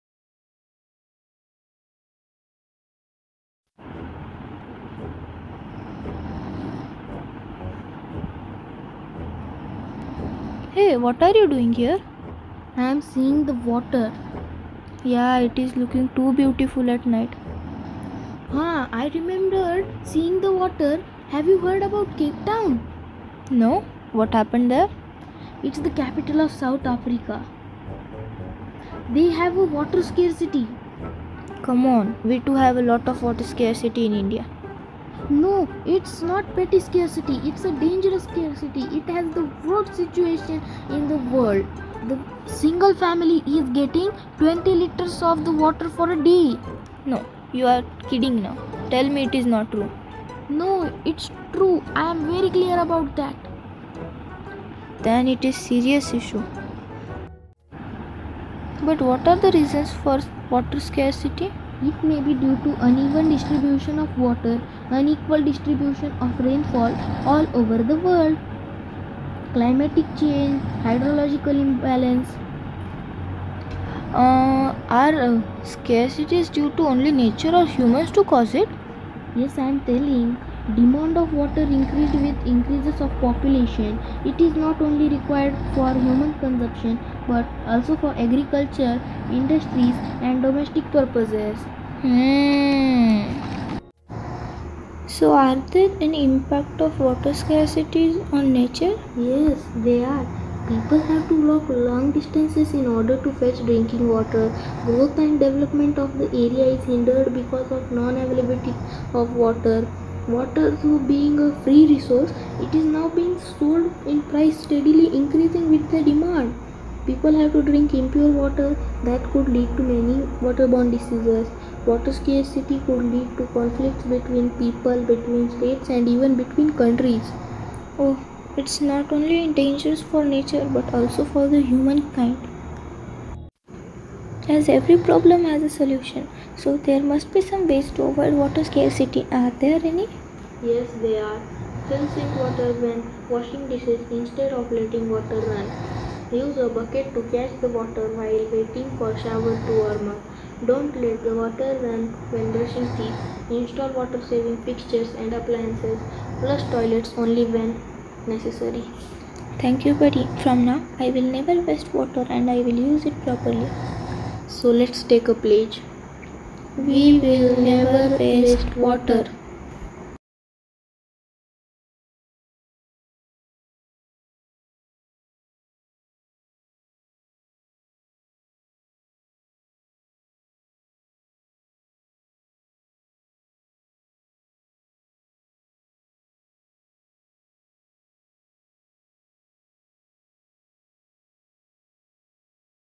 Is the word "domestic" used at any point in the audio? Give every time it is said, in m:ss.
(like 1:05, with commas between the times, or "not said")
1:30.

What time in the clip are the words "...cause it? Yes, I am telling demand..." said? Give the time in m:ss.
1:18.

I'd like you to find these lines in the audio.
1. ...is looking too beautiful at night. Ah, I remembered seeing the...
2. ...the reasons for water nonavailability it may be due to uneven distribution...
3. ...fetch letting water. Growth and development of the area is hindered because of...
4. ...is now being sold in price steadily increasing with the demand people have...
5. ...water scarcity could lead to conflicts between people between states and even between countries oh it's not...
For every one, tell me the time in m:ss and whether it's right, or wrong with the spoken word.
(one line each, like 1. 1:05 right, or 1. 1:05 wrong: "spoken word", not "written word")
1. 0:15 right
2. 0:59 wrong: "scarcity", not "nonavailability"
3. 1:43 wrong: "drinking", not "letting"
4. 1:52 right
5. 2:01 right.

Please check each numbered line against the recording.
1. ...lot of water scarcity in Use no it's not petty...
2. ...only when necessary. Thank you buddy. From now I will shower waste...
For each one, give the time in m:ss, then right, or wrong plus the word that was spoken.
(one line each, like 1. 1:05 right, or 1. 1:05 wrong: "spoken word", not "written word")
1. 0:32 wrong: "India", not "Use"
2. 2:37 wrong: "never", not "shower".